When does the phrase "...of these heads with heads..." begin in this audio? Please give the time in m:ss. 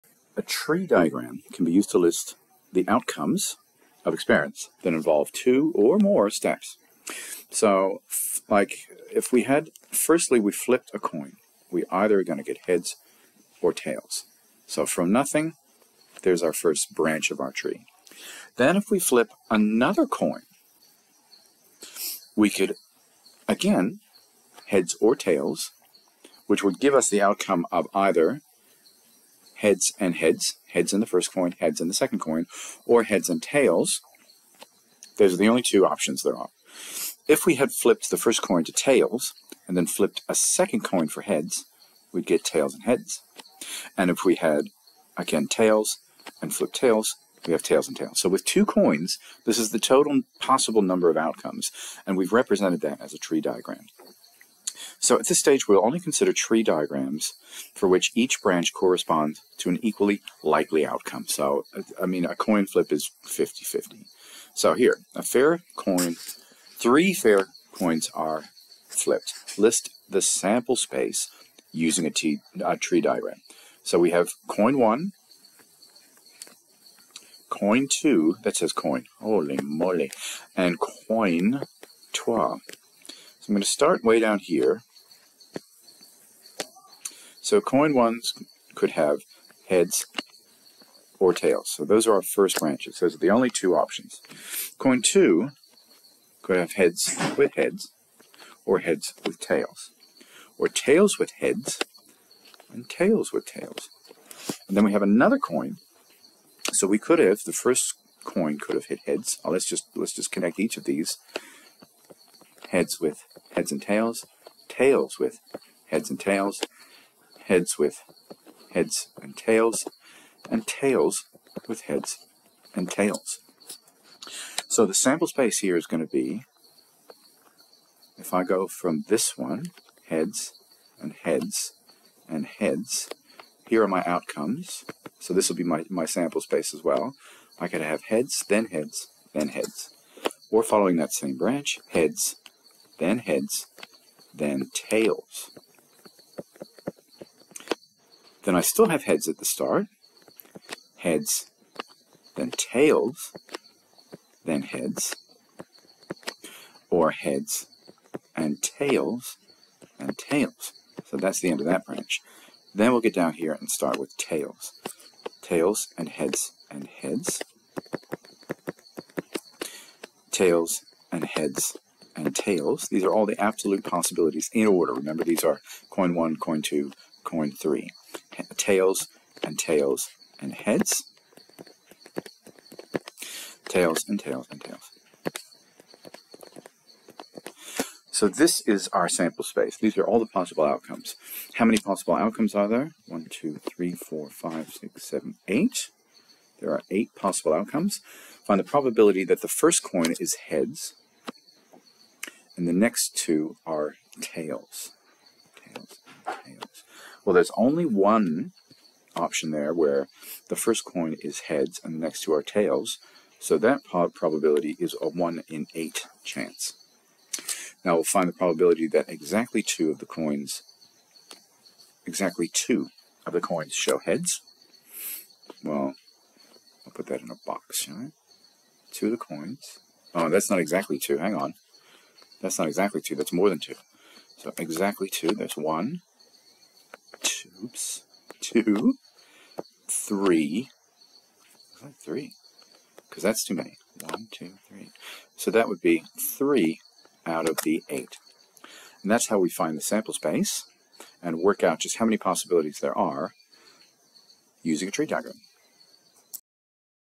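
1:50.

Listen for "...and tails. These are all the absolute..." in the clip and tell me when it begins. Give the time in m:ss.
2:52.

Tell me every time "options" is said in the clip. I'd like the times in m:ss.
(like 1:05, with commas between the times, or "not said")
0:35, 1:33, 3:29.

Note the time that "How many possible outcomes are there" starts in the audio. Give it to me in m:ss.
3:11.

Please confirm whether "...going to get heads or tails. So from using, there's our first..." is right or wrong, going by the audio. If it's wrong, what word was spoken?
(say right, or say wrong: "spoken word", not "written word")
wrong: "nothing", not "using".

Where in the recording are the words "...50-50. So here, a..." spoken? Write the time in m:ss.
1:03.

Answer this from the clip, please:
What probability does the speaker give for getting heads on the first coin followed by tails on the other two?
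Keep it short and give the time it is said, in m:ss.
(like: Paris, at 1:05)
1 in 8, at 3:35.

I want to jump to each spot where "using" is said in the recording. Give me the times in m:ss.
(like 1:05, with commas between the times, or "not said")
1:11, 4:14.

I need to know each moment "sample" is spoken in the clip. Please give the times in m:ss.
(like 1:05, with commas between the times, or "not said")
1:10, 2:04, 2:16, 3:09, 4:09.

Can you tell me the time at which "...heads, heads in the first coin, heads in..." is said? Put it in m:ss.
0:30.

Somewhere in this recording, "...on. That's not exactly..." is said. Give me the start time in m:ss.
3:51.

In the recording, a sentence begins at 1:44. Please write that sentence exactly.
And then we have another coin.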